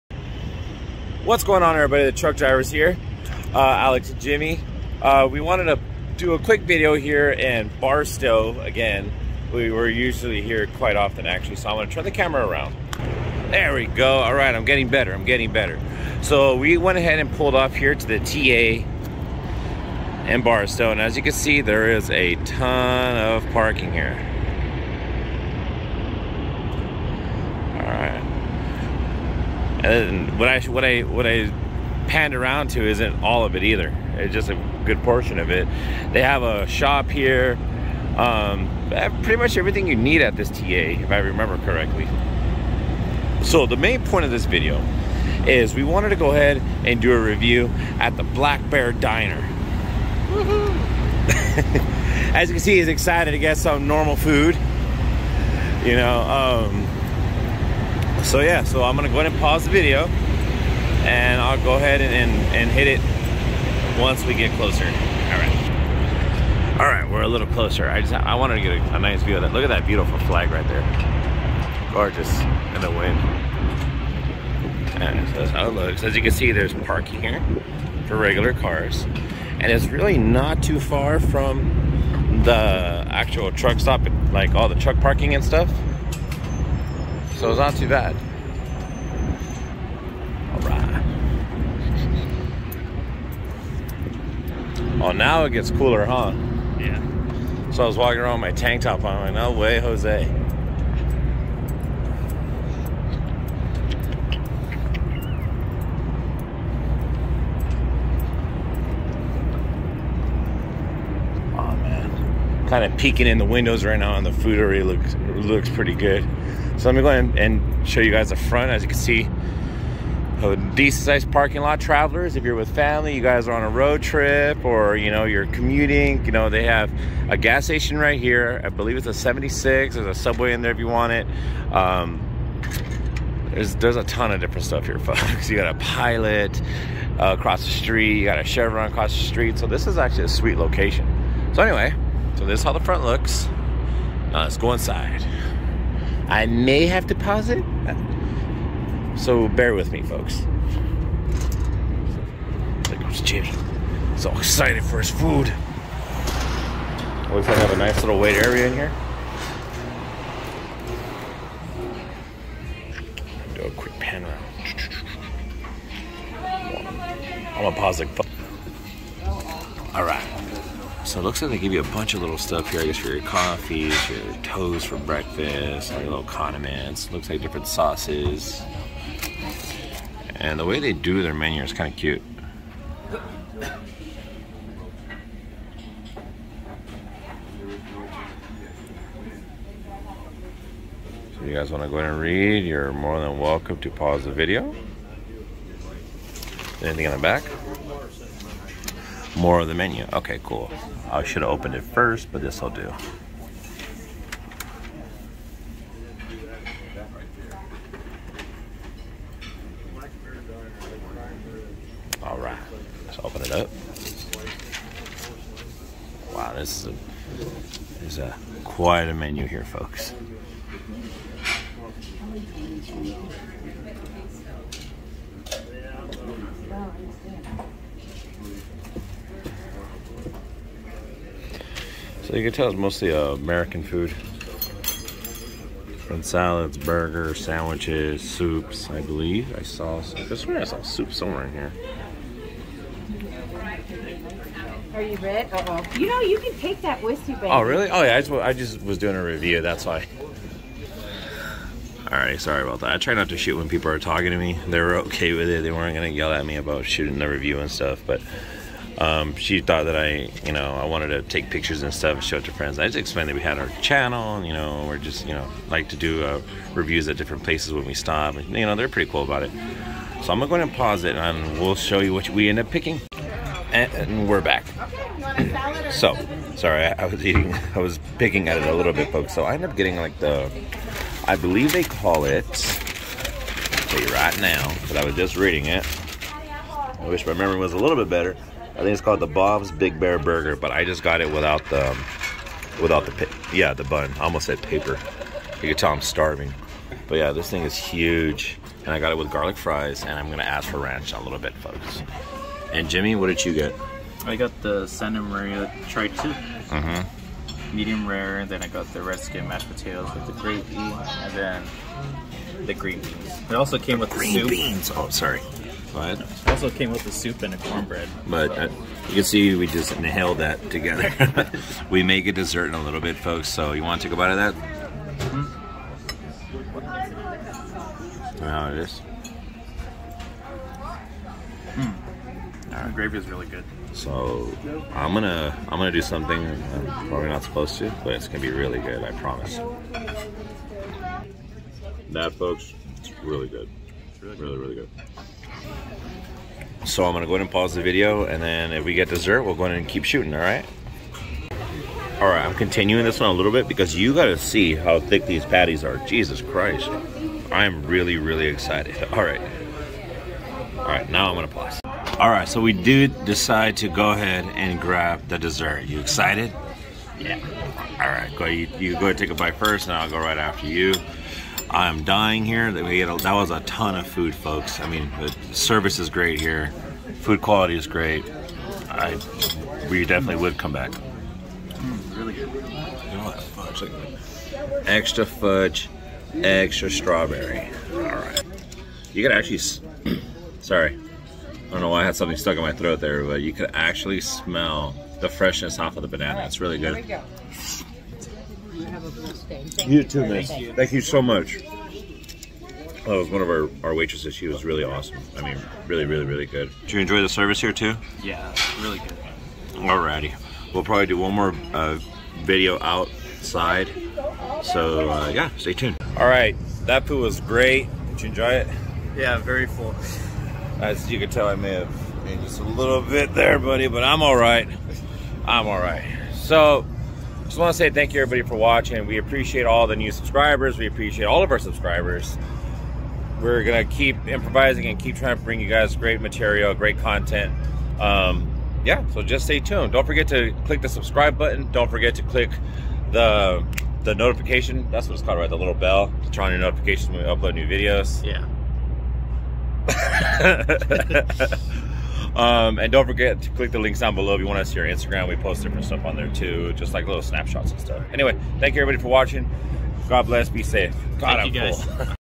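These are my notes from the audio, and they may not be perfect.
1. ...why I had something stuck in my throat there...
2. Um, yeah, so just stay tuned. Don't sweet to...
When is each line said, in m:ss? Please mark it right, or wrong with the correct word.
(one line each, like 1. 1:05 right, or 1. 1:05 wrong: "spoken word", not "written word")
1. 6:31 right
2. 7:17 wrong: "forget", not "sweet".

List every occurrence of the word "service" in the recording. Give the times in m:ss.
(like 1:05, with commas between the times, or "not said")
6:15, 6:47.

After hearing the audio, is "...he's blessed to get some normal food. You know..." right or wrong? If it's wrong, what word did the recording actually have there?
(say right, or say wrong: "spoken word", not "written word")
wrong: "excited", not "blessed".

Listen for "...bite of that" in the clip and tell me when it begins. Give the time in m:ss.
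5:24.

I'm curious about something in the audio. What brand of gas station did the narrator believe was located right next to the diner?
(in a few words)
76.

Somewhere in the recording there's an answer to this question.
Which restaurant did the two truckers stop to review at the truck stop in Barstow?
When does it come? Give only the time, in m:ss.
0:48.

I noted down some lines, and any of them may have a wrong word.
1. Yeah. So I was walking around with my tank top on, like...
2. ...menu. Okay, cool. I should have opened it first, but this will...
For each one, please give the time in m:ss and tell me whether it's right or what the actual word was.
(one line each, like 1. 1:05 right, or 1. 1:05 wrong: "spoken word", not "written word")
1. 1:36 right
2. 3:19 right.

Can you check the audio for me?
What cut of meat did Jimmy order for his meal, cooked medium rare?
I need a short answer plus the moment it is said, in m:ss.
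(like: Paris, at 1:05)
Santa Maria tri-tip, at 5:04.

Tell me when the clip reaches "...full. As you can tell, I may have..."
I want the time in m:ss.
6:59.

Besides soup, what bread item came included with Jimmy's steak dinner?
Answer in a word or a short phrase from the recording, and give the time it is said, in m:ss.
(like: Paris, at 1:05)
Cornbread, at 5:17.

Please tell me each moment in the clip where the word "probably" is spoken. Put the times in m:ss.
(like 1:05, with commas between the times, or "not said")
5:37, 6:50.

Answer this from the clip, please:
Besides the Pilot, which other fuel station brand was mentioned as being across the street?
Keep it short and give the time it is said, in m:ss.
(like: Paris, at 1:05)
Chevron, at 2:18.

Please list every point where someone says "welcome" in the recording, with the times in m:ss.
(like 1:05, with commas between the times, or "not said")
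3:13.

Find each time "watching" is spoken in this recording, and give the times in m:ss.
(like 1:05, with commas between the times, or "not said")
7:08, 7:39.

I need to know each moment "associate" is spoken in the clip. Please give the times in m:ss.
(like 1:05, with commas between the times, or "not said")
not said.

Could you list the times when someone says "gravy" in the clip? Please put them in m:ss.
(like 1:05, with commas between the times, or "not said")
5:10, 5:32.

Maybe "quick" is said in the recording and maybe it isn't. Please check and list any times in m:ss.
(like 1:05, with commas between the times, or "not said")
0:06, 2:43.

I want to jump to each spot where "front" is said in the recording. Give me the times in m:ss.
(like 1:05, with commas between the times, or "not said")
1:58, 2:22.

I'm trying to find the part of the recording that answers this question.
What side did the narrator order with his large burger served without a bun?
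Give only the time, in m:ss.
4:59.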